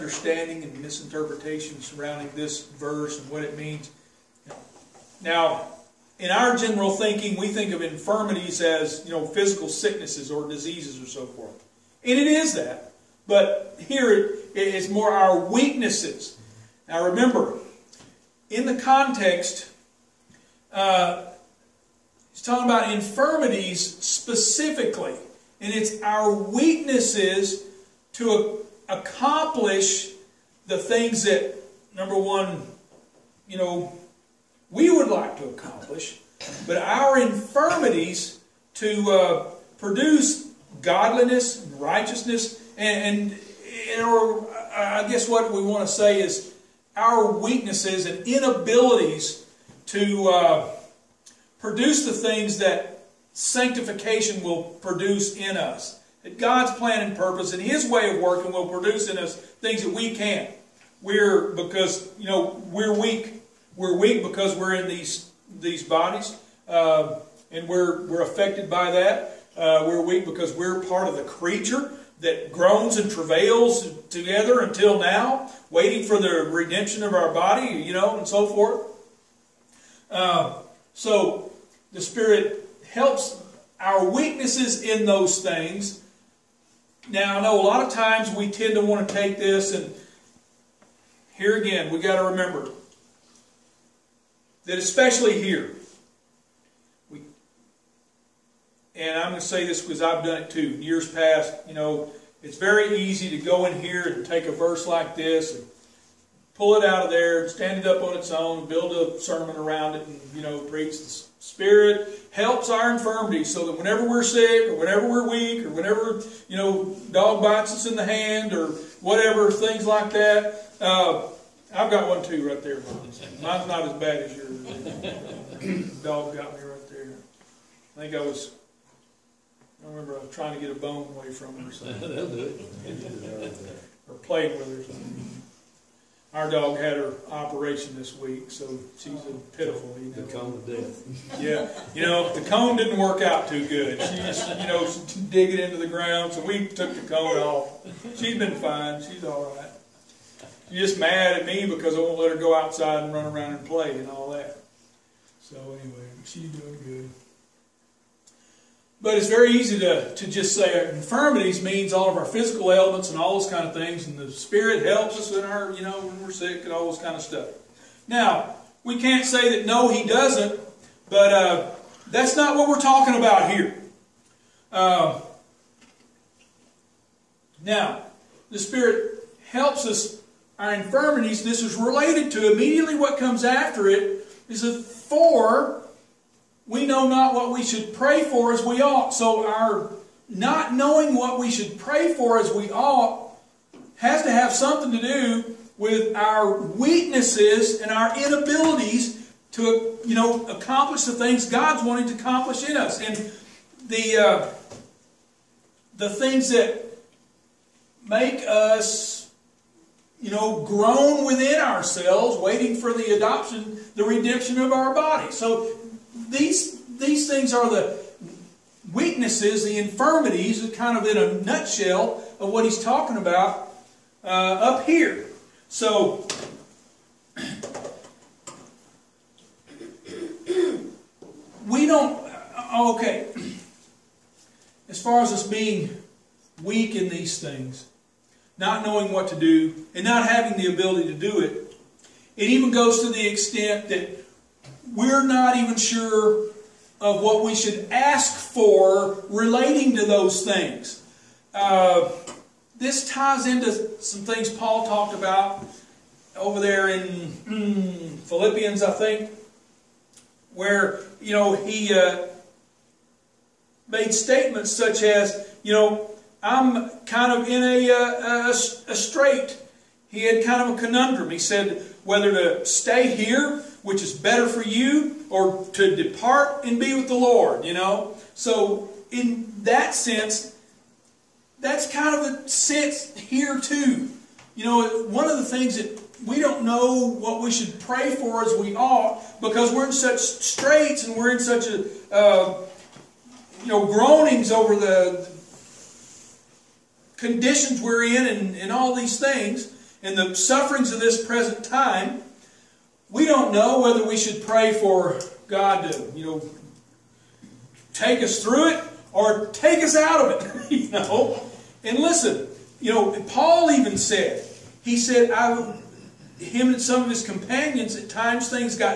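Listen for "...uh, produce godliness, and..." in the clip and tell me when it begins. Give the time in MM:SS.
00:39.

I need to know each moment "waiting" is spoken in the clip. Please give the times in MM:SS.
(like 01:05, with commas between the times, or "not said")
01:15, 03:32.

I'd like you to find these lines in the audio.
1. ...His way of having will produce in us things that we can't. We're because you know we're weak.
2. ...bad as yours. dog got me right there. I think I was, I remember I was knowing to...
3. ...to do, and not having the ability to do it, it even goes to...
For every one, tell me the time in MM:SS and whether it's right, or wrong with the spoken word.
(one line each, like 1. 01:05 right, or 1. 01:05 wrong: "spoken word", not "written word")
1. 00:57 wrong: "working", not "having"
2. 02:03 wrong: "trying", not "knowing"
3. 03:59 right.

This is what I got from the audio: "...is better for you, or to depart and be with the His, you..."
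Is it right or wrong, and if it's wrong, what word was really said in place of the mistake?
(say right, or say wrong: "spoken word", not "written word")
wrong: "Lord", not "His".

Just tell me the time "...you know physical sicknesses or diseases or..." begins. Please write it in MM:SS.
00:09.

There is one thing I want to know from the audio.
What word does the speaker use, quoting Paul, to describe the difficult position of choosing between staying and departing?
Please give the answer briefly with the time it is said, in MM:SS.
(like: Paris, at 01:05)
Strait, at 04:28.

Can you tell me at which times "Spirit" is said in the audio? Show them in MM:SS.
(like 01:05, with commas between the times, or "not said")
01:22, 01:51, 02:44, 02:58.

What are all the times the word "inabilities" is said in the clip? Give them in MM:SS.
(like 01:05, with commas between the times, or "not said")
00:48, 03:18.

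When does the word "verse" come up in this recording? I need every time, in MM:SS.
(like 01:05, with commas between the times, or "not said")
00:02, 01:44.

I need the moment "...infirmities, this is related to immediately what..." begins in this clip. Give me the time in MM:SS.
03:00.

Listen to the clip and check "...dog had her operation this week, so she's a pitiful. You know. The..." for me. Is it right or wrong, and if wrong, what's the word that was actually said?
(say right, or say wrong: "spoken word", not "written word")
right.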